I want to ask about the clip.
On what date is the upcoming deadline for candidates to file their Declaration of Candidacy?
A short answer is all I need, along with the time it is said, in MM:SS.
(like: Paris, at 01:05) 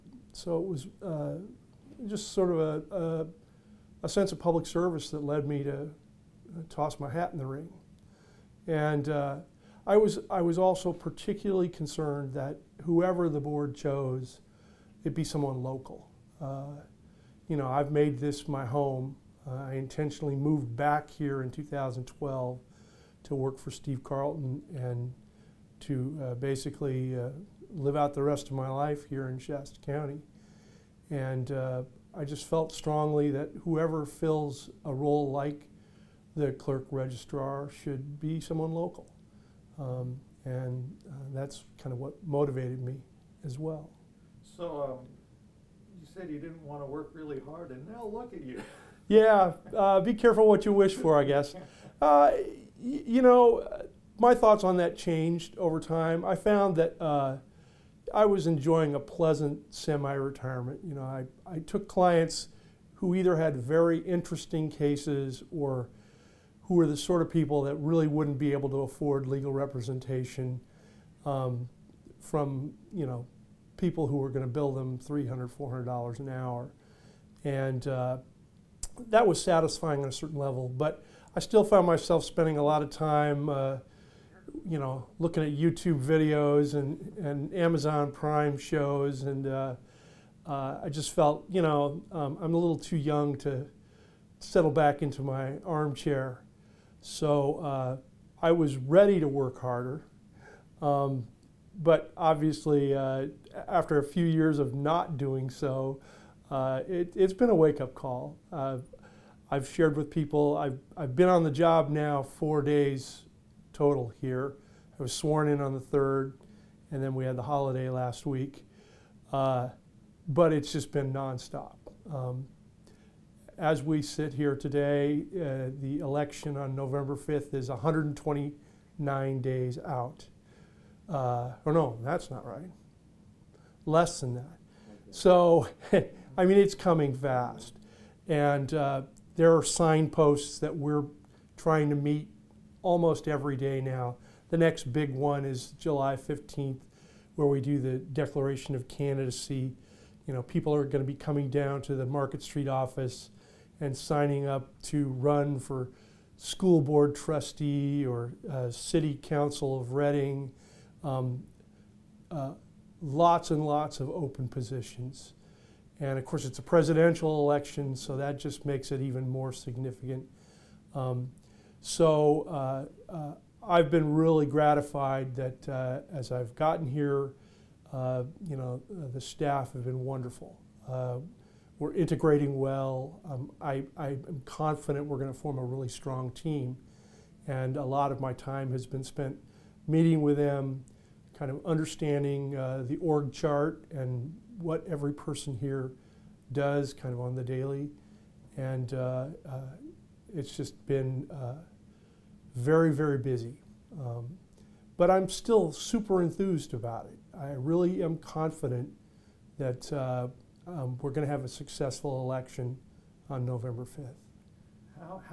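July 15th, at 02:25.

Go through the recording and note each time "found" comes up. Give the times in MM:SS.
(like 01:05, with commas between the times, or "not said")
00:56, 01:21.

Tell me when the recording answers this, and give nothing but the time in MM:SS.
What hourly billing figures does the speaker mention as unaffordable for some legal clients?
01:14.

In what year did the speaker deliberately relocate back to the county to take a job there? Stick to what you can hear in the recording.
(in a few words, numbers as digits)
2012.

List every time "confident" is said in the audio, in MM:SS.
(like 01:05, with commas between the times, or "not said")
03:04, 03:28.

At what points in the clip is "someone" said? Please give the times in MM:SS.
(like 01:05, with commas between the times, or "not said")
00:15, 00:38.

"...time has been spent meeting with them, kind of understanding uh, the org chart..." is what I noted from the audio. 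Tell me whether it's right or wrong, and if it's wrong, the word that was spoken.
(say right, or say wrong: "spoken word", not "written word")
right.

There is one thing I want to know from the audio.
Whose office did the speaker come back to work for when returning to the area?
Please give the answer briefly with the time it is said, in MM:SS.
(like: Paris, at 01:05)
Steve Carlton, at 00:23.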